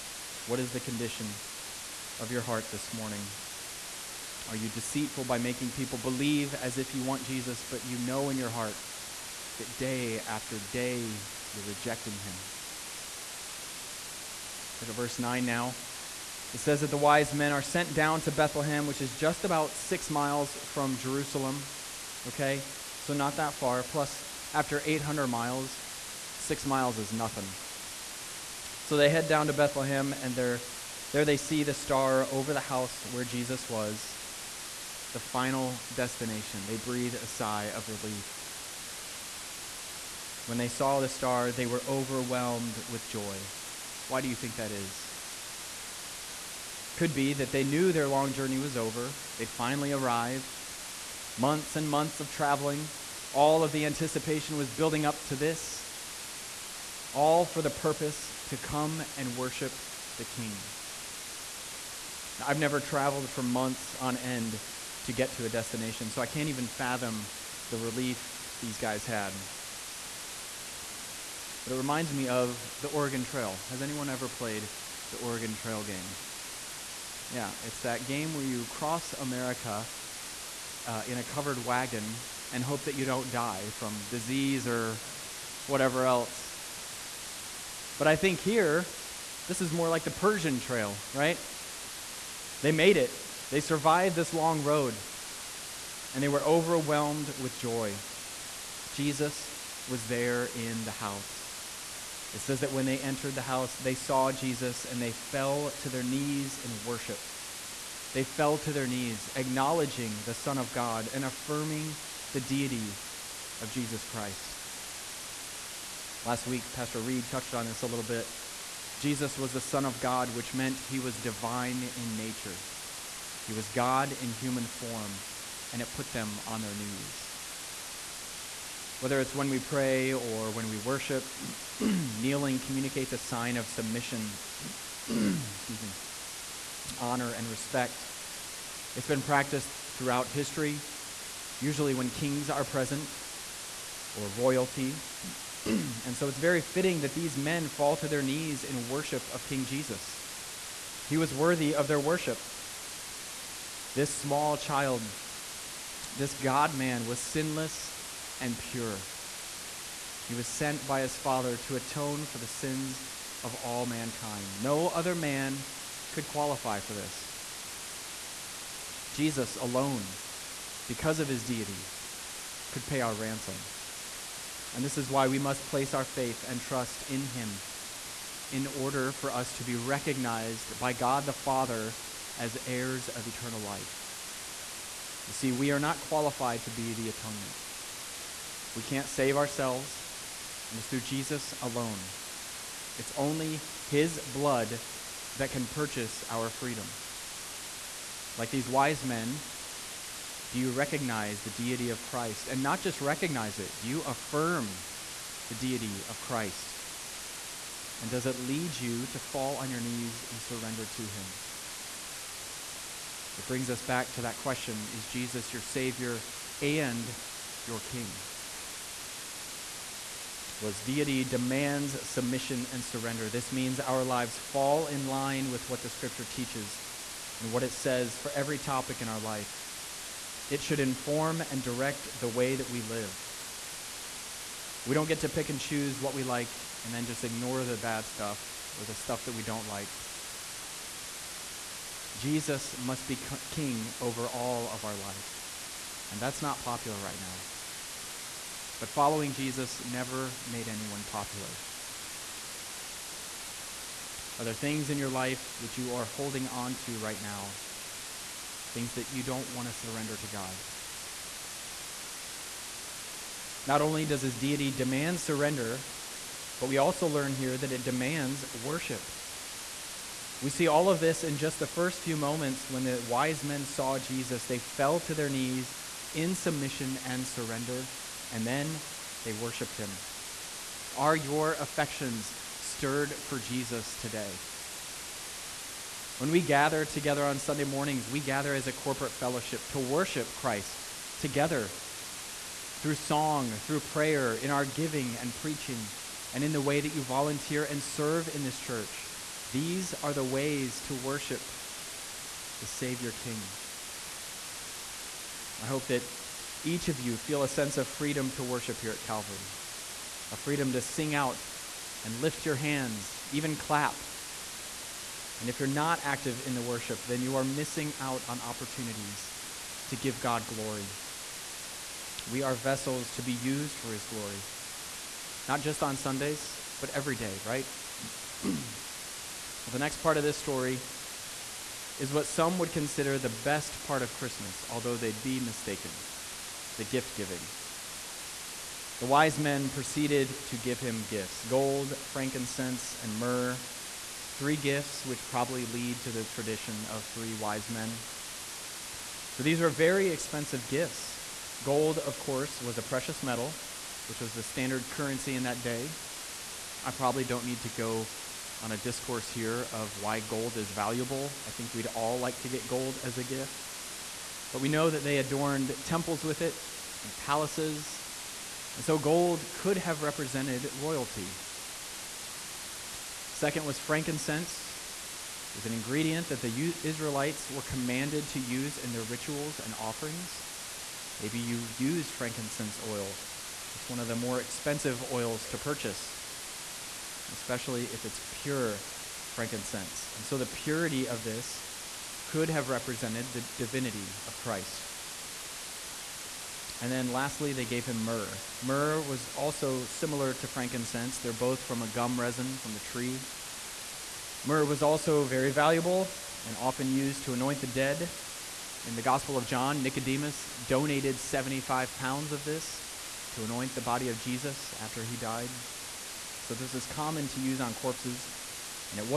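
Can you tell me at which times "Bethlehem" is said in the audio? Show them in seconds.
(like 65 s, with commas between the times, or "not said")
18 s, 29 s.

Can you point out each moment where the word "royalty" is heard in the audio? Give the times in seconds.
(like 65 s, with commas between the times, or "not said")
144 s, 370 s.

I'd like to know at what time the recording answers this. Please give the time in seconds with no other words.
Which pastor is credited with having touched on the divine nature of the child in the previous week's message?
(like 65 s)
116 s.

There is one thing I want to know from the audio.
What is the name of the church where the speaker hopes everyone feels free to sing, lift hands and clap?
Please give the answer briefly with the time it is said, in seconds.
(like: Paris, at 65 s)
Calvary, at 309 s.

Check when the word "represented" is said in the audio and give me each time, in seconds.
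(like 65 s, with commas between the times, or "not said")
370 s, 392 s.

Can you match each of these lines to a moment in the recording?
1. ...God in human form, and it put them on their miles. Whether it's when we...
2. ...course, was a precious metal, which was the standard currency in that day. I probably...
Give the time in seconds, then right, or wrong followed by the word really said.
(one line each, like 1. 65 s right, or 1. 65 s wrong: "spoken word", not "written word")
1. 123 s wrong: "knees", not "miles"
2. 352 s right.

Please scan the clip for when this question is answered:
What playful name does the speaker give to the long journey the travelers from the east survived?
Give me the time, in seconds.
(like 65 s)
90 s.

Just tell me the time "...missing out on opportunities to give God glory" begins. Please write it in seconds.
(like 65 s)
317 s.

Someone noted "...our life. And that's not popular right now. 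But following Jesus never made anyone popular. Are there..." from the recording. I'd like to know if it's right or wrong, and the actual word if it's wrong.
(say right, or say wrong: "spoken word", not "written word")
right.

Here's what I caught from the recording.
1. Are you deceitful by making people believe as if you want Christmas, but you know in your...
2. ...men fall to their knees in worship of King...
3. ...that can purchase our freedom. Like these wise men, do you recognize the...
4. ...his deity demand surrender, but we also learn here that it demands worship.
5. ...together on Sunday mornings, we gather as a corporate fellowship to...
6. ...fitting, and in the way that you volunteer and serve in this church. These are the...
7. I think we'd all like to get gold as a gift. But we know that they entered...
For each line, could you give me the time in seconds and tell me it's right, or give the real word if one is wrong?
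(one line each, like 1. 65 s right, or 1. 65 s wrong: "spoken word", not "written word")
1. 4 s wrong: "Jesus", not "Christmas"
2. 147 s right
3. 195 s right
4. 264 s right
5. 286 s right
6. 295 s wrong: "preaching", not "fitting"
7. 361 s wrong: "adorned", not "entered".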